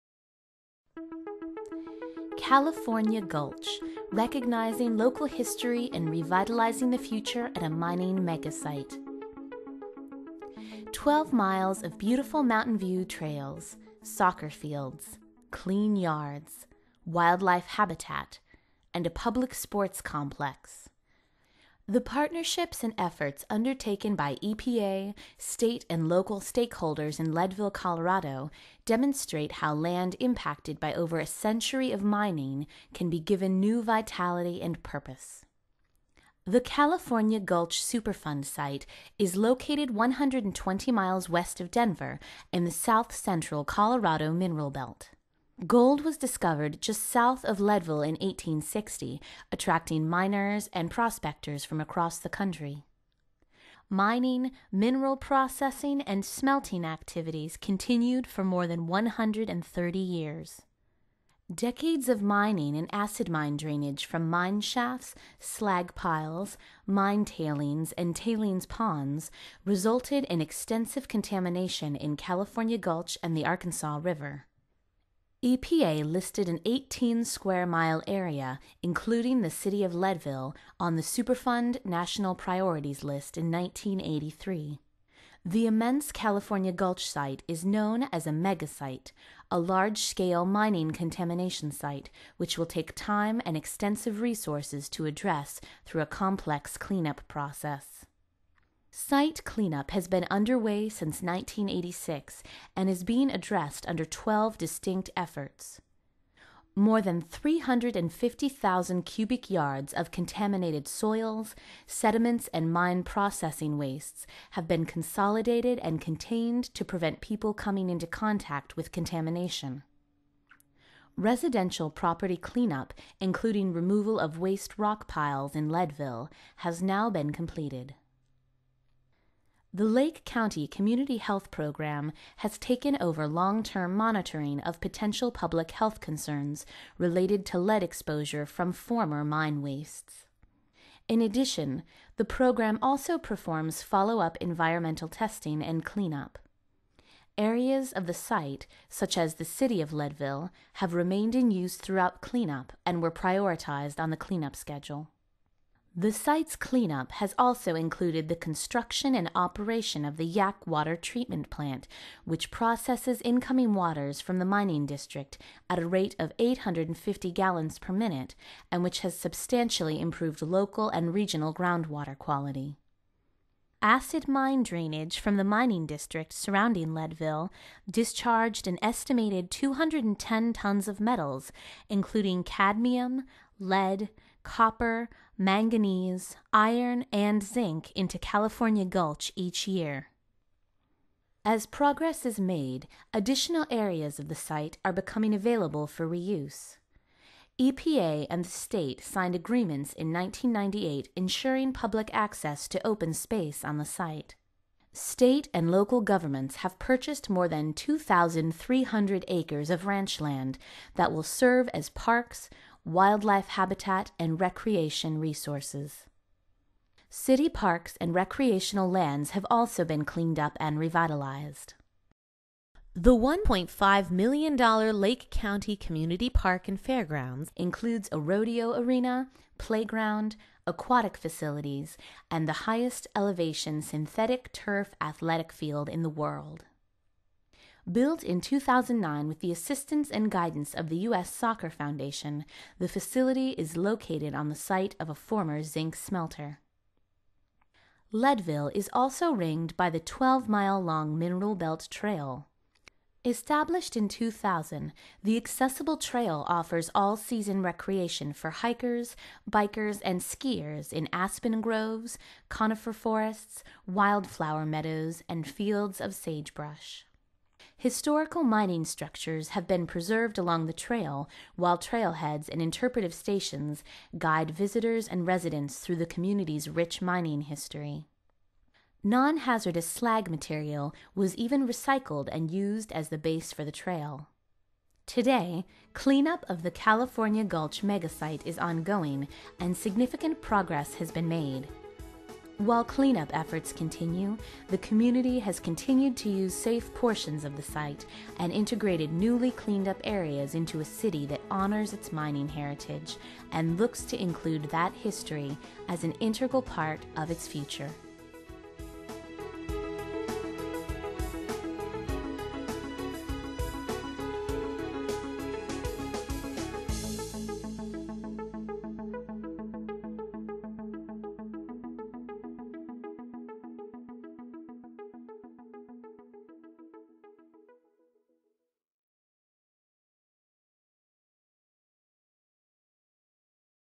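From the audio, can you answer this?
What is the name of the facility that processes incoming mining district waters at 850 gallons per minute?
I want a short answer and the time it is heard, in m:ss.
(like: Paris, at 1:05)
Yak Water Treatment Plant, at 2:40.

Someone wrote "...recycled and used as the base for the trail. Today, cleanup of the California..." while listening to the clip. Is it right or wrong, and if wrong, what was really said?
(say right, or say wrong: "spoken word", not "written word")
right.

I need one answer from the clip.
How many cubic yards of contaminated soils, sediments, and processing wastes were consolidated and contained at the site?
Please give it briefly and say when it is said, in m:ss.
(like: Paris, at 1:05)
350,000, at 1:47.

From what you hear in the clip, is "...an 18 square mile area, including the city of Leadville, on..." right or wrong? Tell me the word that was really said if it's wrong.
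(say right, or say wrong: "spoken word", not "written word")
right.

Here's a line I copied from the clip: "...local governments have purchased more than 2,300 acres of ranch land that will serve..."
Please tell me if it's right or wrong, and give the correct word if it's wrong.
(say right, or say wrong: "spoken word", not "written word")
right.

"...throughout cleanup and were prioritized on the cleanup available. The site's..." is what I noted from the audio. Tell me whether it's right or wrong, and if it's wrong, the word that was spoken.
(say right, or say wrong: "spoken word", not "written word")
wrong: "schedule", not "available".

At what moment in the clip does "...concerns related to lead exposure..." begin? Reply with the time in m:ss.
2:16.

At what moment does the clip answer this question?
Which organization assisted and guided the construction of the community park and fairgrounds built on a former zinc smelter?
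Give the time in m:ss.
4:00.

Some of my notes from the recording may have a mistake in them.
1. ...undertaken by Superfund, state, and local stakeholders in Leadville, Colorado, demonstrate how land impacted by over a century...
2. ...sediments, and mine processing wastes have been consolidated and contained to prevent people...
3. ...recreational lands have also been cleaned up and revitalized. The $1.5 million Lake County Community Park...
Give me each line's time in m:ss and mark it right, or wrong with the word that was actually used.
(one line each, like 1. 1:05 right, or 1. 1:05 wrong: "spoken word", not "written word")
1. 0:23 wrong: "EPA", not "Superfund"
2. 1:51 right
3. 3:38 right.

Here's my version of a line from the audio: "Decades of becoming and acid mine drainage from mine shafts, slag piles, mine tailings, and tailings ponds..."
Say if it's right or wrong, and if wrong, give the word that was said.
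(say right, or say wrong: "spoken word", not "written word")
wrong: "mining", not "becoming".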